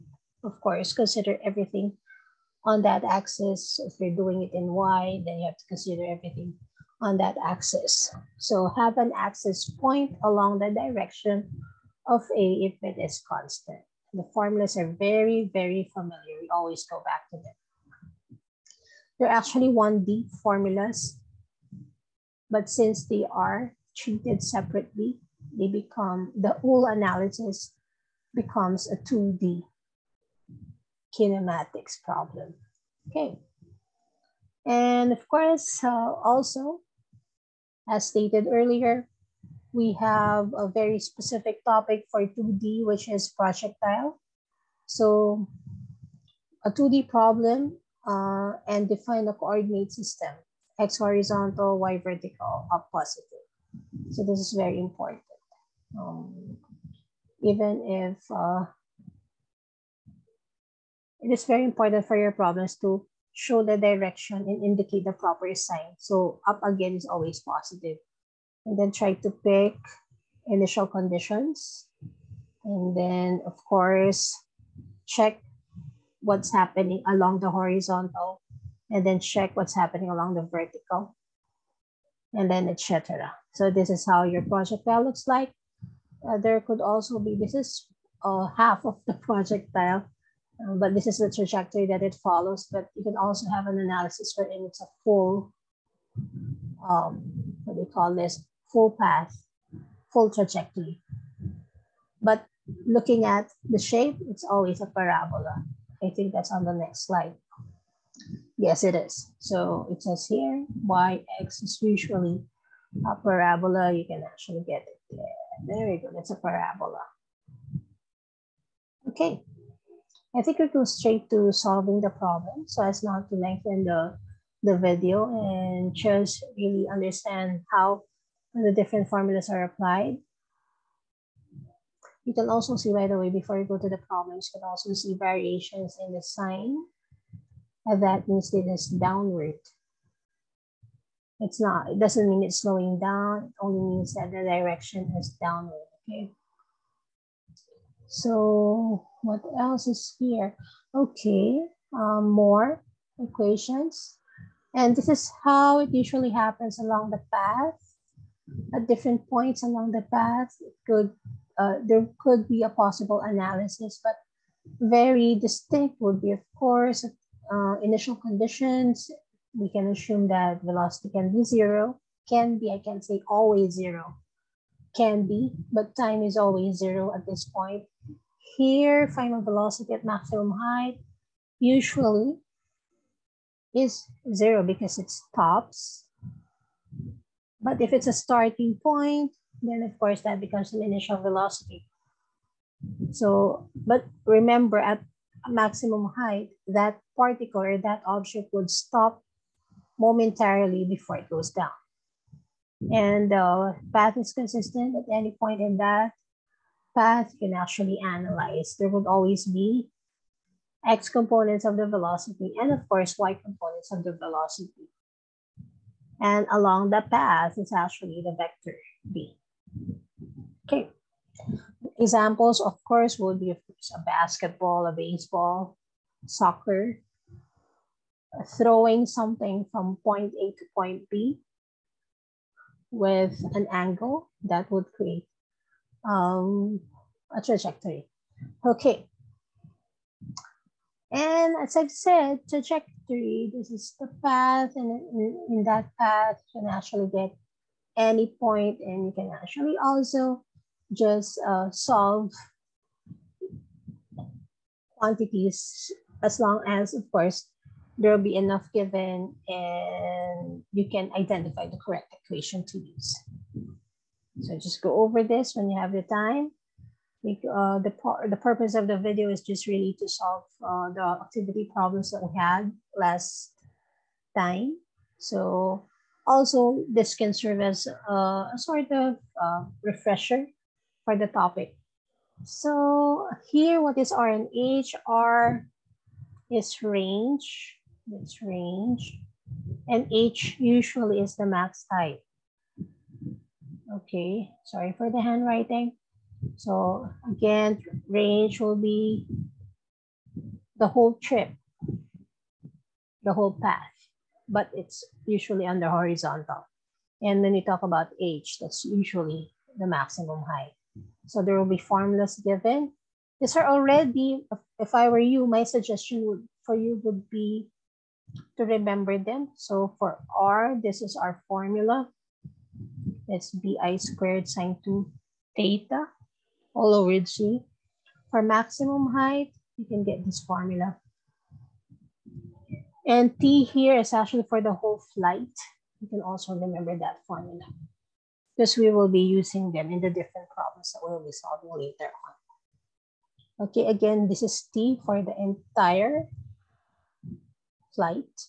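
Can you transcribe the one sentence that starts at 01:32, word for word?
But you can also have an analysis wherein it's a full, um, what do you call this, full path, full trajectory.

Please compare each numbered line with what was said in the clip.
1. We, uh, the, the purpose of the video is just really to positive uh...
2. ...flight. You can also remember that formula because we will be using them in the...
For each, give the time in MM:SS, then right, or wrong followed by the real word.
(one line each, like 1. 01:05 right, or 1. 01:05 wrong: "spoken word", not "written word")
1. 04:27 wrong: "solve", not "positive"
2. 05:35 right.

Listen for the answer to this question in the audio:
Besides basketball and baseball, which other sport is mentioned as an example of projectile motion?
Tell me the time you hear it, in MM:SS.
03:46.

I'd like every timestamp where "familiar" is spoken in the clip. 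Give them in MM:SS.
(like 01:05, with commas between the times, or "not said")
00:15.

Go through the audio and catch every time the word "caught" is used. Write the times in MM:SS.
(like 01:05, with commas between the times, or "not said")
not said.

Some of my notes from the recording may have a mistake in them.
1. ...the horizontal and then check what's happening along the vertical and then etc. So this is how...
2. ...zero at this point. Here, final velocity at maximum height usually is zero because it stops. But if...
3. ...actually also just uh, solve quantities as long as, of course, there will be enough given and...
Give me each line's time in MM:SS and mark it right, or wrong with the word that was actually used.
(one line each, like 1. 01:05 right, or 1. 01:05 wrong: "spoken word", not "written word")
1. 01:17 right
2. 02:56 right
3. 04:09 right.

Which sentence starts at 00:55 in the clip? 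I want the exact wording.
Um, even if uh, it is very important for your problems to show the direction and indicate the proper sign.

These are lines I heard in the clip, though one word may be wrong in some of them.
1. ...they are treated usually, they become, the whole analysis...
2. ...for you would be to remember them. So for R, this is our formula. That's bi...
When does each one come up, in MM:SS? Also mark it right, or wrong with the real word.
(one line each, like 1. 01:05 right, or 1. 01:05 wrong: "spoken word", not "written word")
1. 00:23 wrong: "separately", not "usually"
2. 05:16 right.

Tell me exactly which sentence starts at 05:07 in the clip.
And when you talk about H, that's usually the maximum height.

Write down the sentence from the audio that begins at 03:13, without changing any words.
So, but remember at maximum height, that particle or that object would stop momentarily before it goes down.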